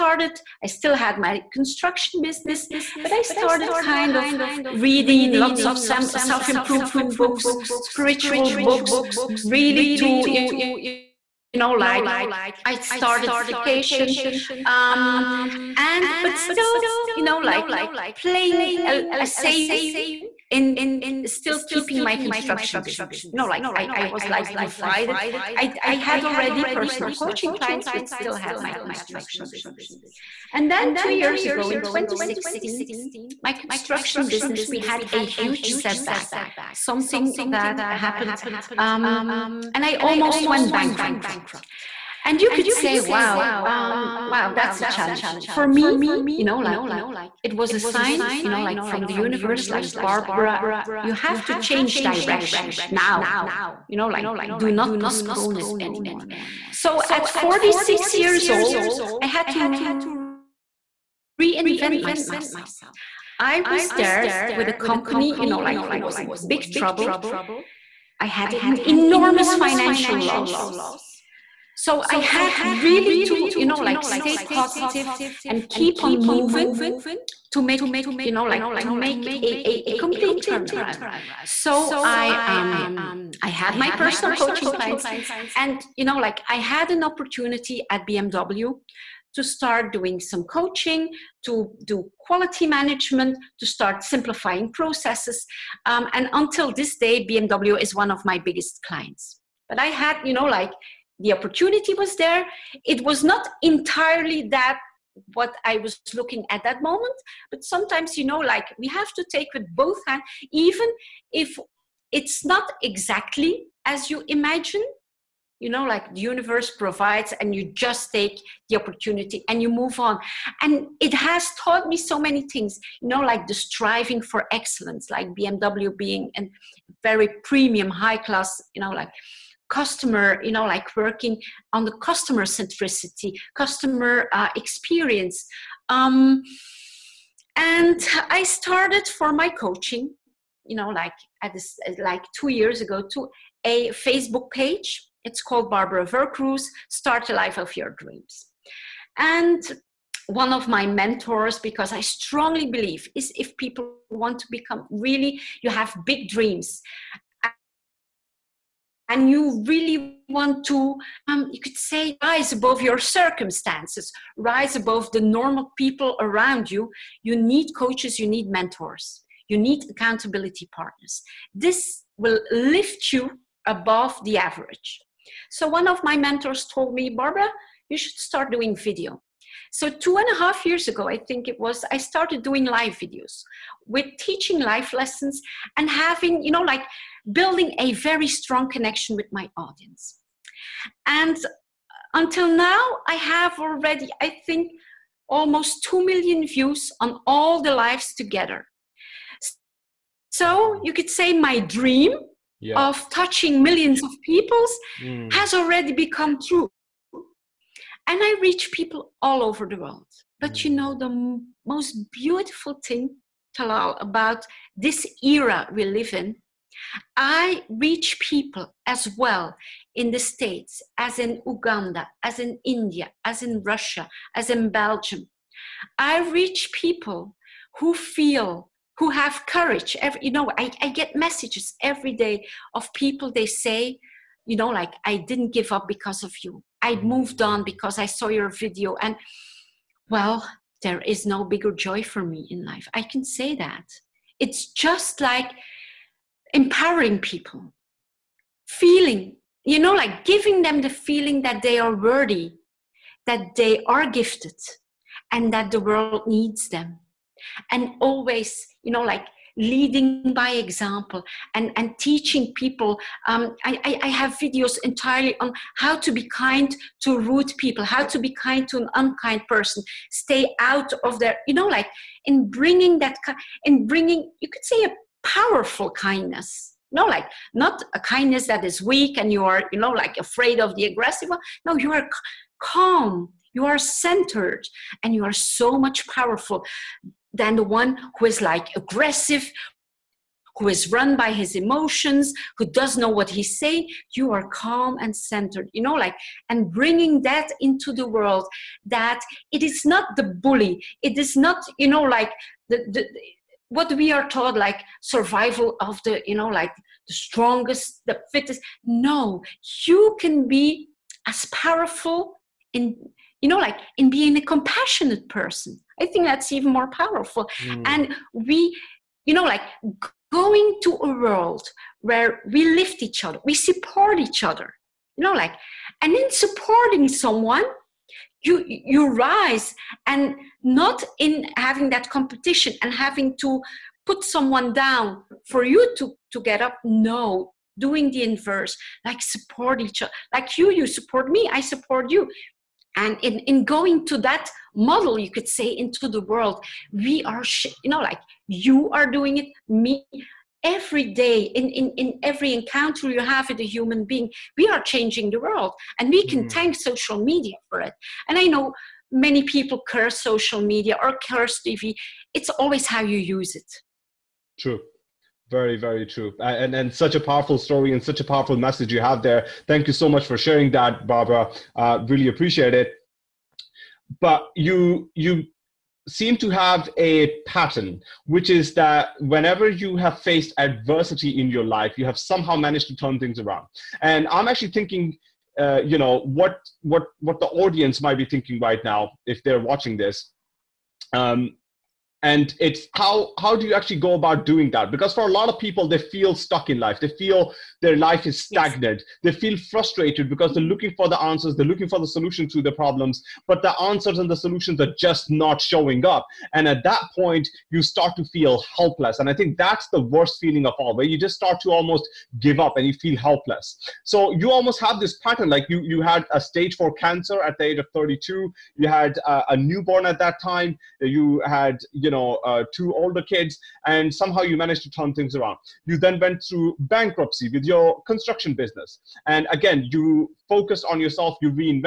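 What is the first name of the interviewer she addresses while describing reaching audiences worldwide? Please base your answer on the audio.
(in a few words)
Tallal.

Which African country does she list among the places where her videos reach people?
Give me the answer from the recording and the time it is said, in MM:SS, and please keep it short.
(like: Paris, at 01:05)
Uganda, at 03:41.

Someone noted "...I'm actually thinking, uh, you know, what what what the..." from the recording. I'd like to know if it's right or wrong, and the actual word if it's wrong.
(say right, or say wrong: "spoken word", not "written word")
right.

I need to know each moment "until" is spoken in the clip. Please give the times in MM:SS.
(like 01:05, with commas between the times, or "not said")
01:36, 03:12.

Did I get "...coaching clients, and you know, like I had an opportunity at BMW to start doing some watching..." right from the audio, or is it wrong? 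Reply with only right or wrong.
wrong.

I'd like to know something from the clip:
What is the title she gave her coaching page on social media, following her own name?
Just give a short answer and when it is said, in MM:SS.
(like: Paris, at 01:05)
Start a Life of Your Dreams, at 02:26.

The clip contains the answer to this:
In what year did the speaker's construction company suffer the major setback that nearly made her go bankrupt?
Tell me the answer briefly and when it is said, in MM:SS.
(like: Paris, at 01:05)
2016, at 00:31.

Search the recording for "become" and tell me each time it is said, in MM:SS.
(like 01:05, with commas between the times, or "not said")
02:34, 03:25.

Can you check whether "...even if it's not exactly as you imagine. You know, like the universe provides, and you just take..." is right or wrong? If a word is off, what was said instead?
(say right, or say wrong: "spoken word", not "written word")
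right.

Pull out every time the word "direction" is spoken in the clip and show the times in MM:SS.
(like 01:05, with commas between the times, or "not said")
00:52.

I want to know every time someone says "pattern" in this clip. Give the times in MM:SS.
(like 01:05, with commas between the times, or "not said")
06:17, 06:55.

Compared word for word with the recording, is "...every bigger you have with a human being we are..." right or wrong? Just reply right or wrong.
wrong.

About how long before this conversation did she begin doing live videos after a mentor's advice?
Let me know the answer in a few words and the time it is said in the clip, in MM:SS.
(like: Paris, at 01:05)
two and a half years, at 02:59.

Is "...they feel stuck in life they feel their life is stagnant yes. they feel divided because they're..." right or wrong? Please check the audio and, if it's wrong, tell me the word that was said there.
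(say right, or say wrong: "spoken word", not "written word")
wrong: "frustrated", not "divided".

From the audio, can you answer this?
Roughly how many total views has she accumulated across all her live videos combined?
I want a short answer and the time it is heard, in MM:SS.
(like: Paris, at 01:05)
almost 2 million, at 03:15.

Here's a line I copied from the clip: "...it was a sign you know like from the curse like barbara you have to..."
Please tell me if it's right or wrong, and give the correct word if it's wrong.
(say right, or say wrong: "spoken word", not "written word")
wrong: "universe", not "curse".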